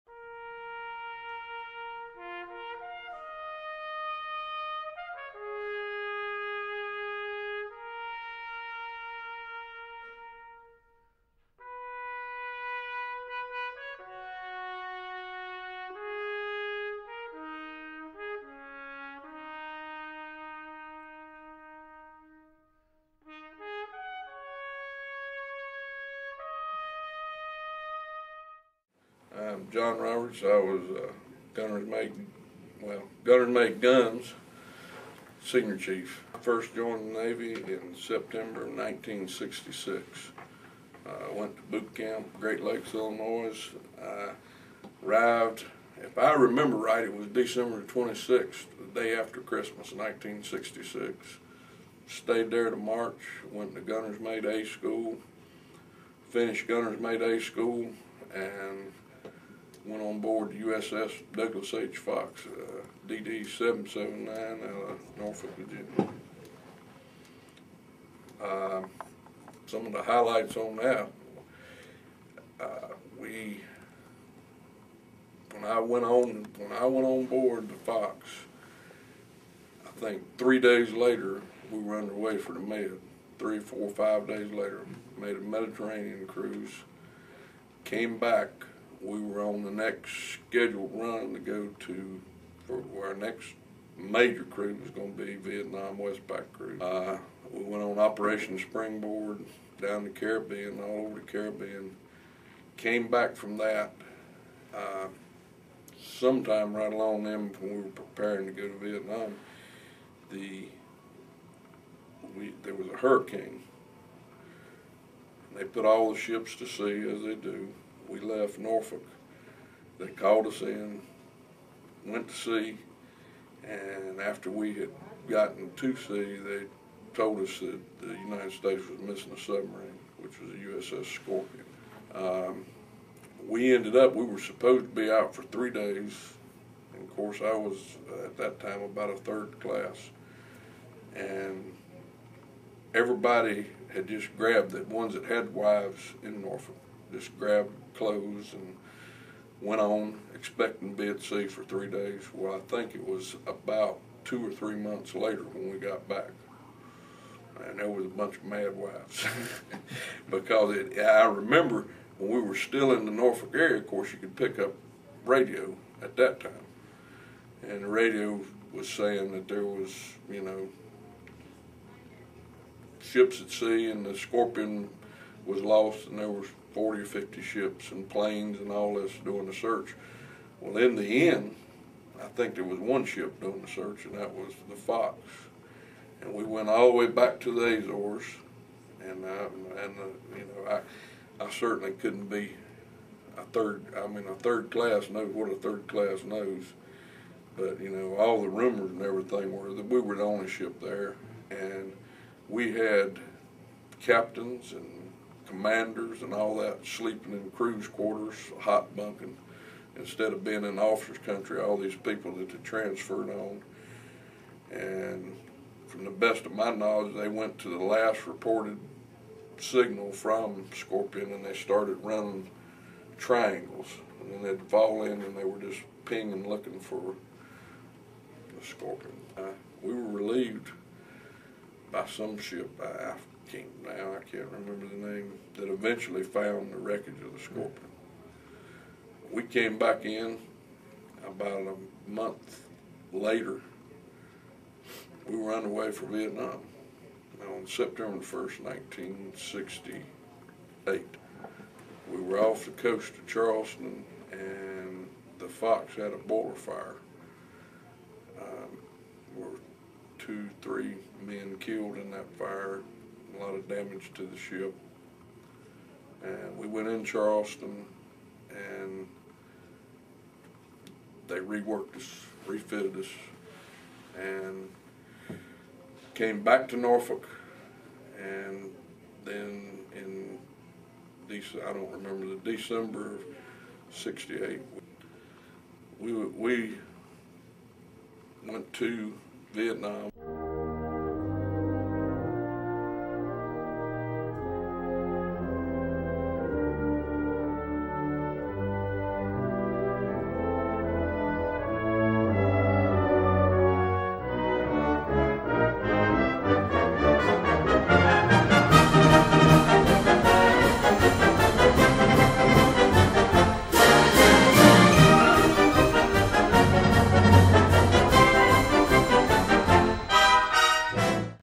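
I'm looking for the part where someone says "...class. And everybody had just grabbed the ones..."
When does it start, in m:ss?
2:19.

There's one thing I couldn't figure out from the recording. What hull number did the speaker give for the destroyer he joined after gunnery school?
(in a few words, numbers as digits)
DD 779.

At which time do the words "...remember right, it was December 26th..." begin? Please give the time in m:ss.
0:46.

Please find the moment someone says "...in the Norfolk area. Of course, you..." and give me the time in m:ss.
2:42.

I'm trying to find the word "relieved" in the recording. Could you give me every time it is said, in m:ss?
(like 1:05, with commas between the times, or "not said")
3:50.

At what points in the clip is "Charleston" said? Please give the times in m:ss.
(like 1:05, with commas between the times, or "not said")
4:13, 4:27.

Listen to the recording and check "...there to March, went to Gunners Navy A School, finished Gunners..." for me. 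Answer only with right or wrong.
wrong.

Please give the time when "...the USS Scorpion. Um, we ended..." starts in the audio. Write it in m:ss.
2:10.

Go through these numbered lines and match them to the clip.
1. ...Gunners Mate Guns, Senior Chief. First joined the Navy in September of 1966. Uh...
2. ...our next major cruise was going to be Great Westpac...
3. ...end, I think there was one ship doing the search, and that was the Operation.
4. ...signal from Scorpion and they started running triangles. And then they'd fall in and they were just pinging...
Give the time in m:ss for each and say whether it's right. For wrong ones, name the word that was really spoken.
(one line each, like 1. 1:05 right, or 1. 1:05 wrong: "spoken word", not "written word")
1. 0:33 right
2. 1:33 wrong: "Vietnam", not "Great"
3. 3:01 wrong: "Fox", not "Operation"
4. 3:39 right.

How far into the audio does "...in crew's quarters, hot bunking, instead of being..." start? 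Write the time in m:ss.
3:27.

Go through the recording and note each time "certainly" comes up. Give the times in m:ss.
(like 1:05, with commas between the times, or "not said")
3:11.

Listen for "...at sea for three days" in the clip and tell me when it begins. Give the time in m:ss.
2:31.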